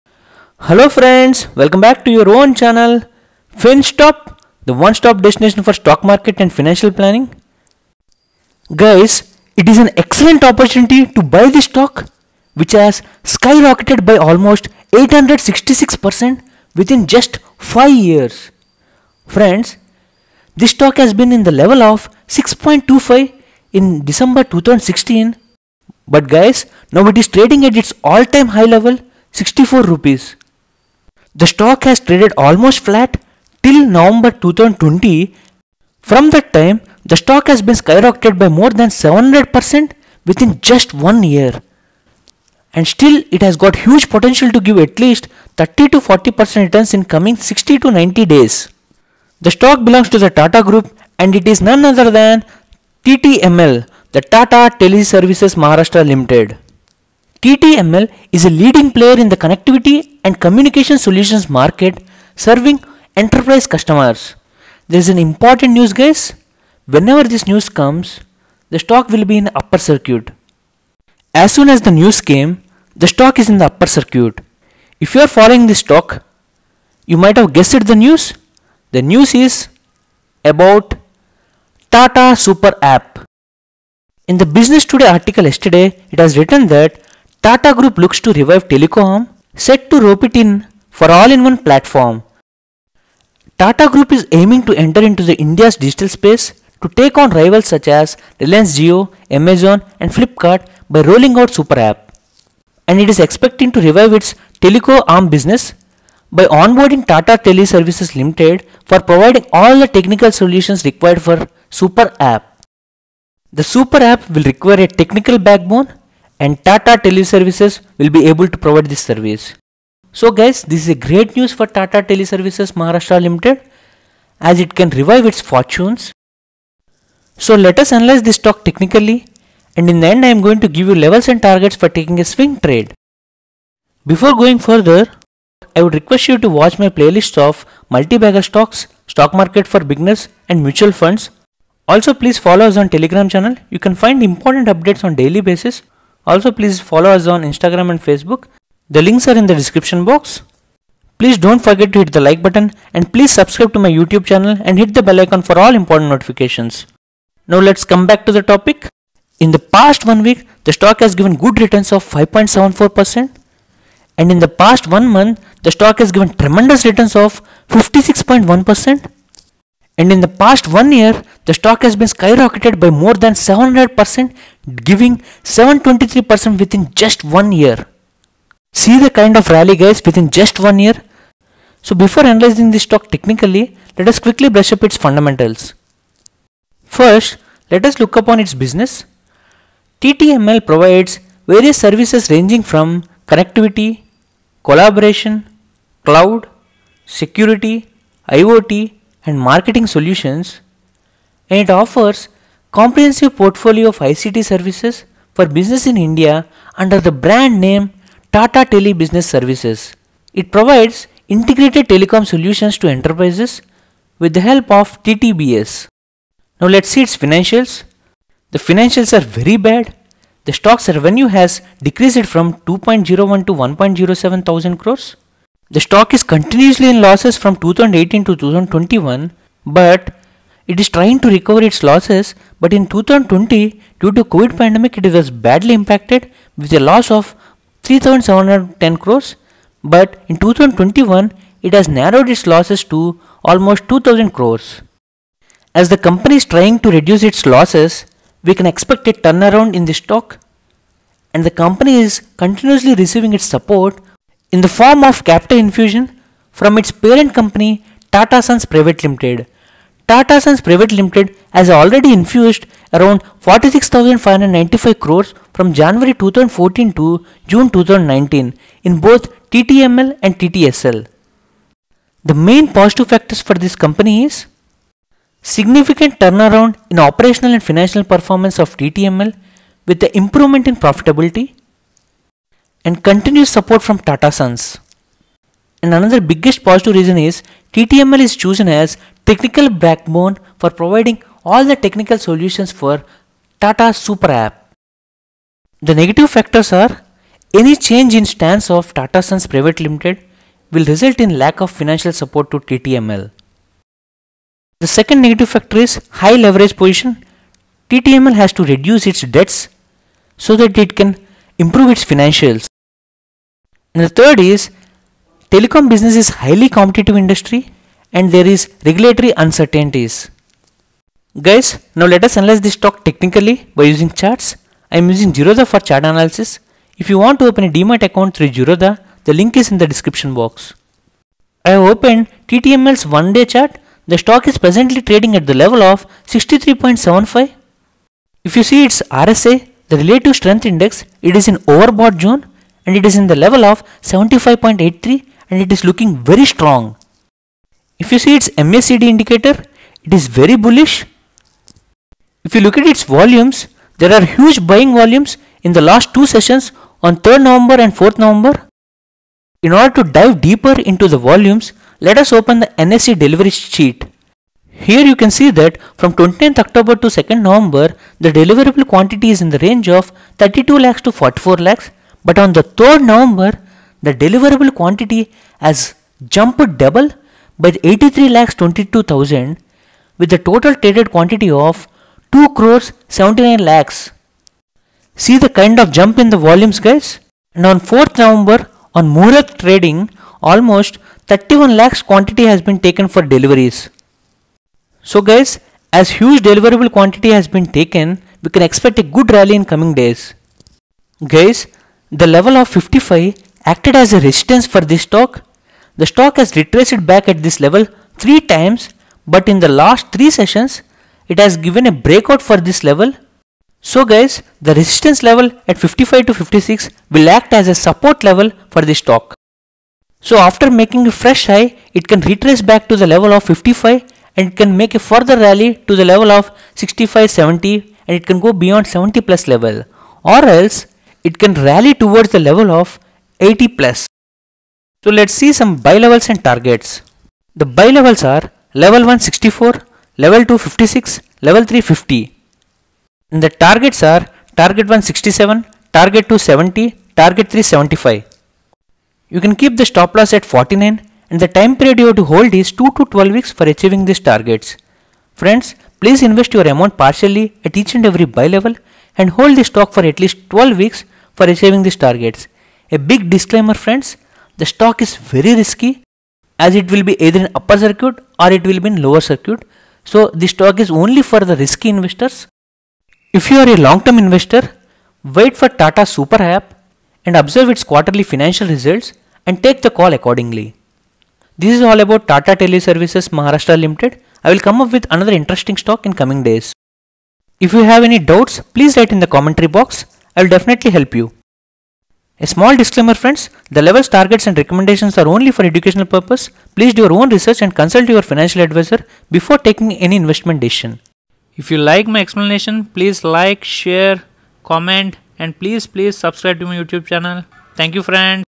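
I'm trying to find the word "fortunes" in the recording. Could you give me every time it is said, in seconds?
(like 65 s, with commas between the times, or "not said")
125 s.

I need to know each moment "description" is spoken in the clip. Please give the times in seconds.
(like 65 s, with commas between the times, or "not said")
149 s, 329 s.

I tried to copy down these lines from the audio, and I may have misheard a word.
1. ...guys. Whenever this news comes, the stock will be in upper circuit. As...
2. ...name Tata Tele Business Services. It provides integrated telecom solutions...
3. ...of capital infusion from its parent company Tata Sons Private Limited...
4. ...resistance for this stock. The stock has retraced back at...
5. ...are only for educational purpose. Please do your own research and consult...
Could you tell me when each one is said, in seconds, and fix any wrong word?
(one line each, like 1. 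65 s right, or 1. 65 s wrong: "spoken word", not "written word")
1. 65 s right
2. 207 s right
3. 255 s right
4. 404 s right
5. 495 s right.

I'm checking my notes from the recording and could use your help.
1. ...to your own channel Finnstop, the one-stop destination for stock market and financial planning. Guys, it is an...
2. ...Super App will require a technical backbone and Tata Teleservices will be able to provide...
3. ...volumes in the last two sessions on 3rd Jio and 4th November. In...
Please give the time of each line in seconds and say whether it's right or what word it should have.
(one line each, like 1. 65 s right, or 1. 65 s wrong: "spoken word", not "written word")
1. 2 s right
2. 113 s right
3. 354 s wrong: "November", not "Jio".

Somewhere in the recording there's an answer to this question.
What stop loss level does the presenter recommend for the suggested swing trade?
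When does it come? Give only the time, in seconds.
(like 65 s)
450 s.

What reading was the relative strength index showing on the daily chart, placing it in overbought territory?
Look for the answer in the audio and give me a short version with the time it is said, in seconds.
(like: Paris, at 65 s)
75.83, at 344 s.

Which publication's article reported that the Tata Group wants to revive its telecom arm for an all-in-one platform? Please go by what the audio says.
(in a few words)
Business Today.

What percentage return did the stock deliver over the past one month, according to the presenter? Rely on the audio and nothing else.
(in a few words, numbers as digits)
56.1%.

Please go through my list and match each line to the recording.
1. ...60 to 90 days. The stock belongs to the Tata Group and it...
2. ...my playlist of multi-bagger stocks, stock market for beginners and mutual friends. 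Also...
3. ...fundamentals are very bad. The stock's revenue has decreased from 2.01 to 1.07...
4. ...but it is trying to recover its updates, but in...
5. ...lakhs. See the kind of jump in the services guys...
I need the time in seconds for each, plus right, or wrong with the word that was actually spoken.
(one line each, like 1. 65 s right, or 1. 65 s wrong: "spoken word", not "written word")
1. 47 s right
2. 136 s wrong: "funds", not "friends"
3. 218 s wrong: "financials", not "fundamentals"
4. 229 s wrong: "losses", not "updates"
5. 383 s wrong: "volumes", not "services".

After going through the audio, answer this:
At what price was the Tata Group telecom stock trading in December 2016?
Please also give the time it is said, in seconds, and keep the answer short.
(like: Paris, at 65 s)
6.25, at 22 s.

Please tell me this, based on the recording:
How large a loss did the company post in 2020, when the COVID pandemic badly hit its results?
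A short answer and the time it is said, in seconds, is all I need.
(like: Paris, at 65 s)
3,710 crores, at 237 s.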